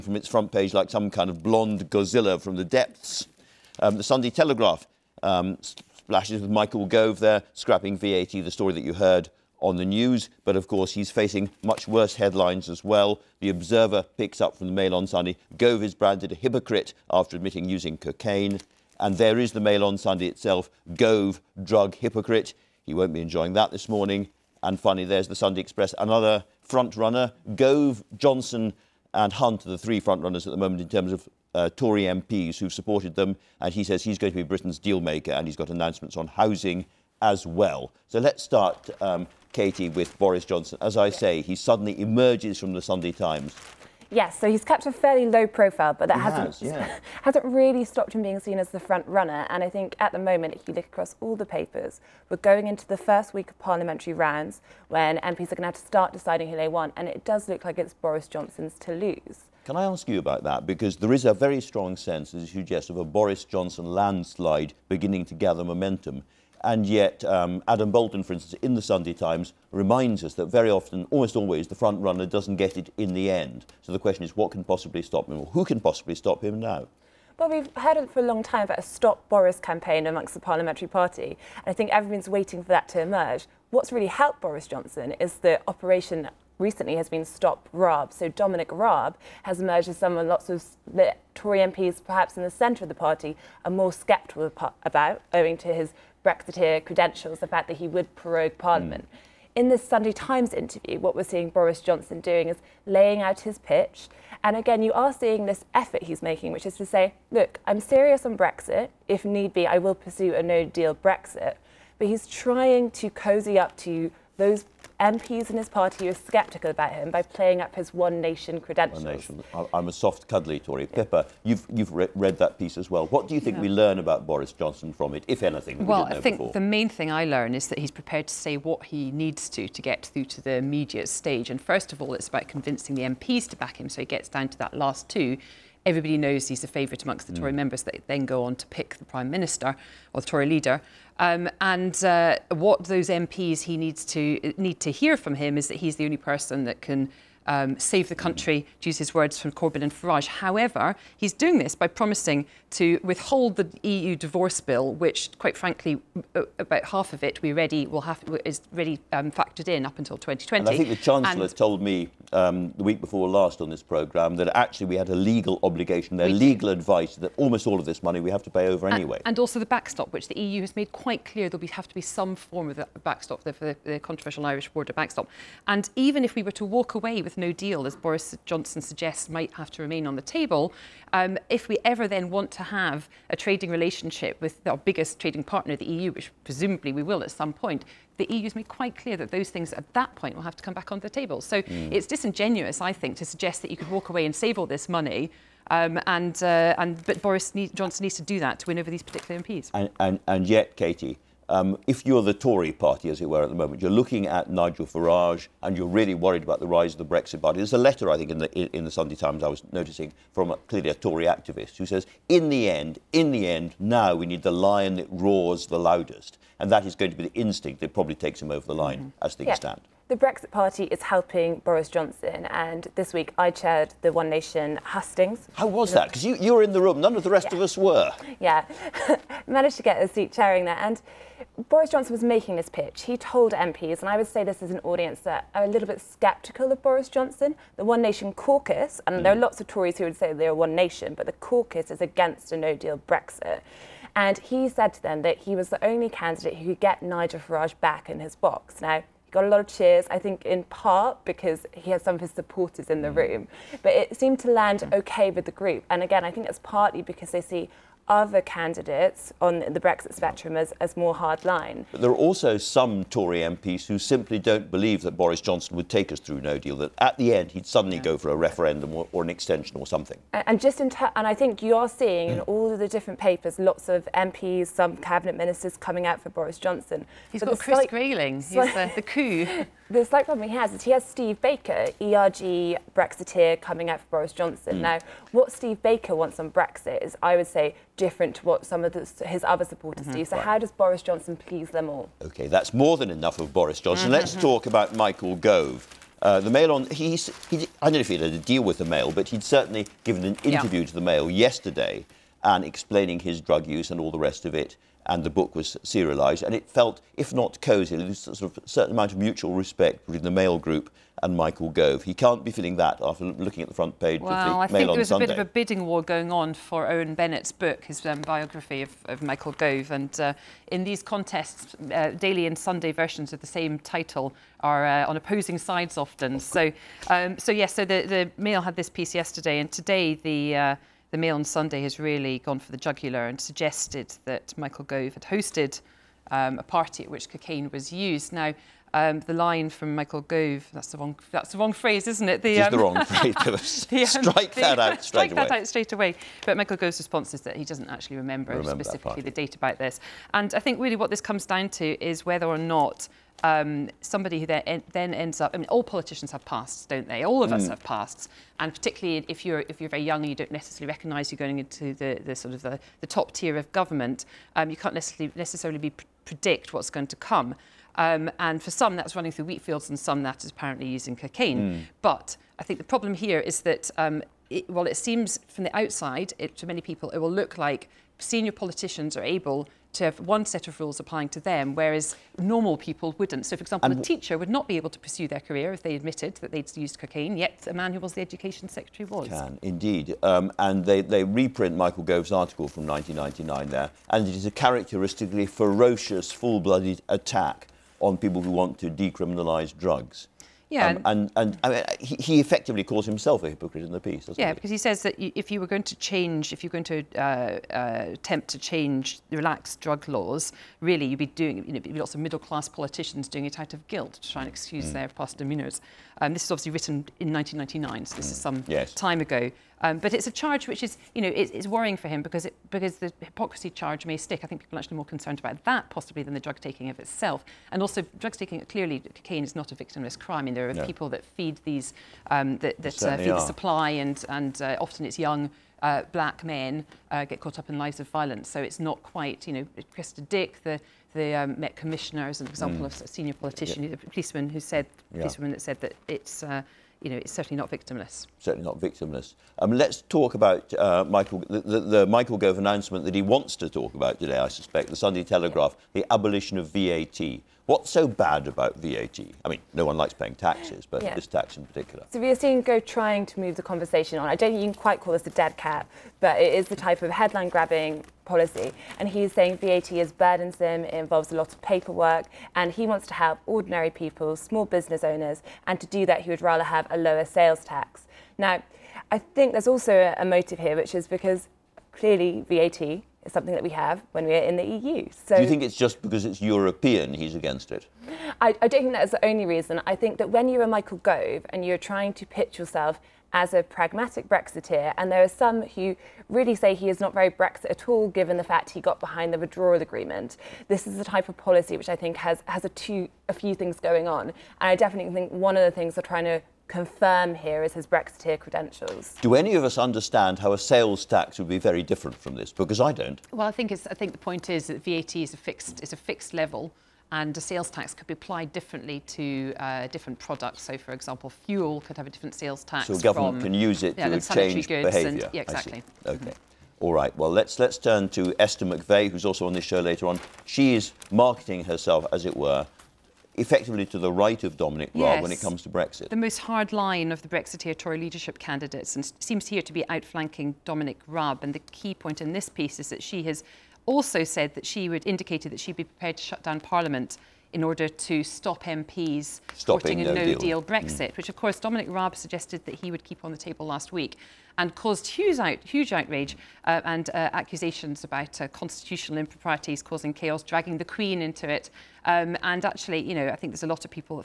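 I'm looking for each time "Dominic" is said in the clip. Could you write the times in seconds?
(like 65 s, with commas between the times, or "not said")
88 s, 534 s, 540 s, 551 s.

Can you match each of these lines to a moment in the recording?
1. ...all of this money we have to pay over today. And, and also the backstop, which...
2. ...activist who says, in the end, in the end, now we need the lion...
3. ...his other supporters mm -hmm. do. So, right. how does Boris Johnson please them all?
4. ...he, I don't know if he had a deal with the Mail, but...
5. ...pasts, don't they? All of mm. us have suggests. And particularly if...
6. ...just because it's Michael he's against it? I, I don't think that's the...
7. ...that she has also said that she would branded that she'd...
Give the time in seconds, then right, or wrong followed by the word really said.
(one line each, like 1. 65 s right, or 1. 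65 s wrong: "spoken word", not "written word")
1. 167 s wrong: "anyway", not "today"
2. 211 s right
3. 289 s right
4. 297 s right
5. 356 s wrong: "pasts", not "suggests"
6. 485 s wrong: "European", not "Michael"
7. 542 s wrong: "indicated", not "branded".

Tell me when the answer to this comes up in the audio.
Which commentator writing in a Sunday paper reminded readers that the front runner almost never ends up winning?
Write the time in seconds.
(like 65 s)
67 s.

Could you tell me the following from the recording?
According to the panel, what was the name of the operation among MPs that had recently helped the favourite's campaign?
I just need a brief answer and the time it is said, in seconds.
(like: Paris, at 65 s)
Stop Raab, at 87 s.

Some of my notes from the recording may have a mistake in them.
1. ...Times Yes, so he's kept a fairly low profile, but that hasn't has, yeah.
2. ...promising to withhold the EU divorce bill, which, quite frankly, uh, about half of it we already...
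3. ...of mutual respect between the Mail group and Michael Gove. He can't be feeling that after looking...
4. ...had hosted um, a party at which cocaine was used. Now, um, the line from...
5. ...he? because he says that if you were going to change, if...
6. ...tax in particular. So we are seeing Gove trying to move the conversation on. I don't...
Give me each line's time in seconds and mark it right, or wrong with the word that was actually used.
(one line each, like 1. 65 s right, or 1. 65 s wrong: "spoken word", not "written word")
1. 43 s right
2. 151 s right
3. 309 s right
4. 335 s right
5. 404 s right
6. 461 s right.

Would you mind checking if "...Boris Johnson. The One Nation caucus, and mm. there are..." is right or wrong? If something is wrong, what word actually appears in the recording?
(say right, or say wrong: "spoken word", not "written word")
right.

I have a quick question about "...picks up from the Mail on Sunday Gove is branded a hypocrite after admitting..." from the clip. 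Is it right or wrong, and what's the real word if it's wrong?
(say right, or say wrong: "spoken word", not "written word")
right.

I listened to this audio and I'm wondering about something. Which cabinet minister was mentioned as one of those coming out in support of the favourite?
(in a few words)
Grayling.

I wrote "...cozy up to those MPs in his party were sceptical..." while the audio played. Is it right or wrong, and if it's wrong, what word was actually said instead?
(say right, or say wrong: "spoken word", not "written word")
right.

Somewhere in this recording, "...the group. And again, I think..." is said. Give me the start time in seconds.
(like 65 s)
255 s.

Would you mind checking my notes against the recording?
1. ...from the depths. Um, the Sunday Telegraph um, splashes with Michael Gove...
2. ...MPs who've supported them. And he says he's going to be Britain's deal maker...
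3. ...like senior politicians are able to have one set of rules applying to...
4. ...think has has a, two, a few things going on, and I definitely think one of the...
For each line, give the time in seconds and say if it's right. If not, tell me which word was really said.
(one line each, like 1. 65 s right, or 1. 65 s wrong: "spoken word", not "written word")
1. 2 s right
2. 32 s right
3. 377 s right
4. 501 s right.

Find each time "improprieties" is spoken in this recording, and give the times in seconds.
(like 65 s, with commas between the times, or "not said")
559 s.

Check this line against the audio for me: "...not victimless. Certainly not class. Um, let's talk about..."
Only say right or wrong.
wrong.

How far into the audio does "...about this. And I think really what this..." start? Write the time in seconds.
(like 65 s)
349 s.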